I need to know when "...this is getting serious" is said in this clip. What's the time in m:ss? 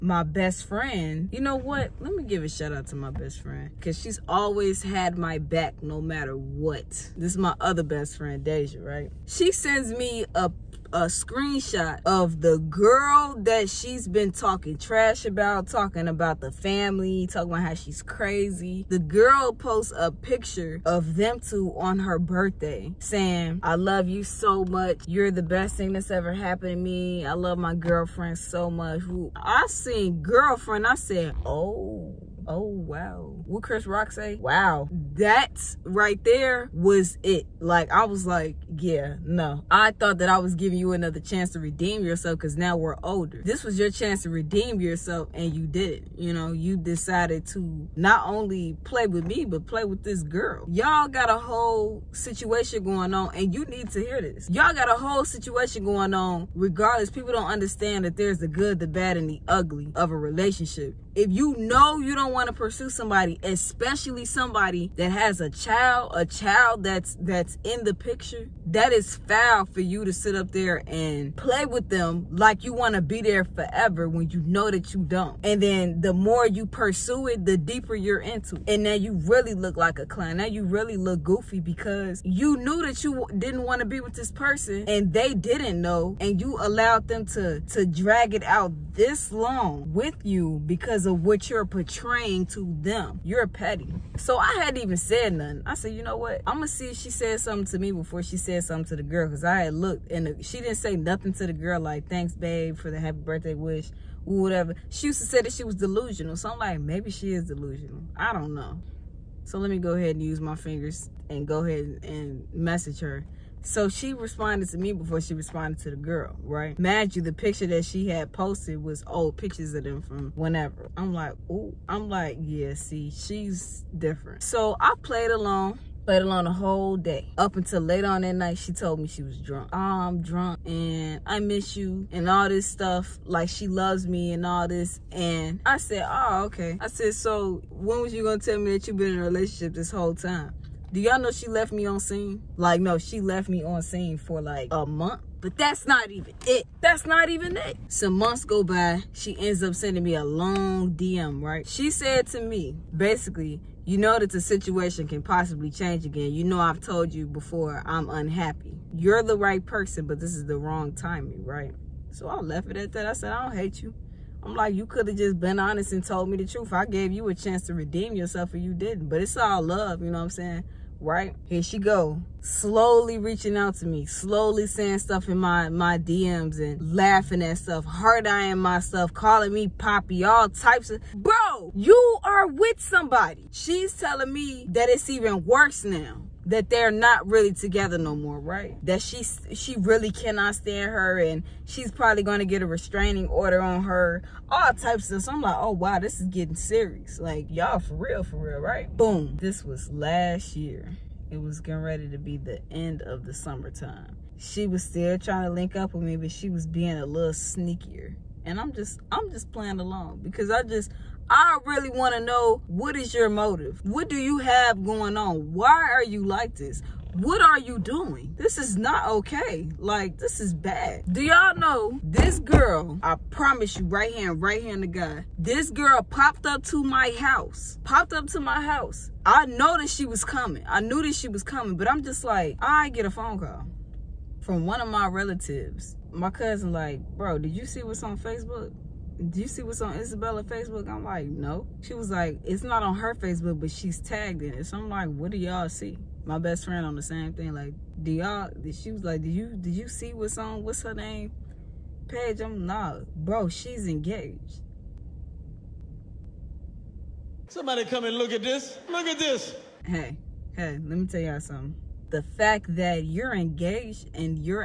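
3:15.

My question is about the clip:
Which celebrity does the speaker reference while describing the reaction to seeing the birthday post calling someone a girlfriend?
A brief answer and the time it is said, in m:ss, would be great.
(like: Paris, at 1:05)
Chris Rock, at 0:33.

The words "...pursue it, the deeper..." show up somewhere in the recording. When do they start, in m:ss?
1:16.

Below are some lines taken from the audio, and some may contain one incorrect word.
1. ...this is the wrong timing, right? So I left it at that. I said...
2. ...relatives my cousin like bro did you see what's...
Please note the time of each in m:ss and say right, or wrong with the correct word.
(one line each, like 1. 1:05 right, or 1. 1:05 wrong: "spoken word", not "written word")
1. 2:40 right
2. 3:55 right.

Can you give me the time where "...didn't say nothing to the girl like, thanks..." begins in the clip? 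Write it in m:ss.
1:40.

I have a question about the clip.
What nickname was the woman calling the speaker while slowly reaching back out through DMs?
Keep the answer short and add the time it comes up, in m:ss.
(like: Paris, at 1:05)
Poppy, at 2:59.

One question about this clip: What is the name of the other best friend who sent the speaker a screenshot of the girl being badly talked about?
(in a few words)
Deja.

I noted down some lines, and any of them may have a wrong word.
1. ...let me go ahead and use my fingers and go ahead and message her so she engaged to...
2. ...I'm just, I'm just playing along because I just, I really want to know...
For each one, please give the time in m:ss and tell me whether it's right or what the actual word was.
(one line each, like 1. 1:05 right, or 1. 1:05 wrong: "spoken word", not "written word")
1. 1:49 wrong: "responded", not "engaged"
2. 3:28 right.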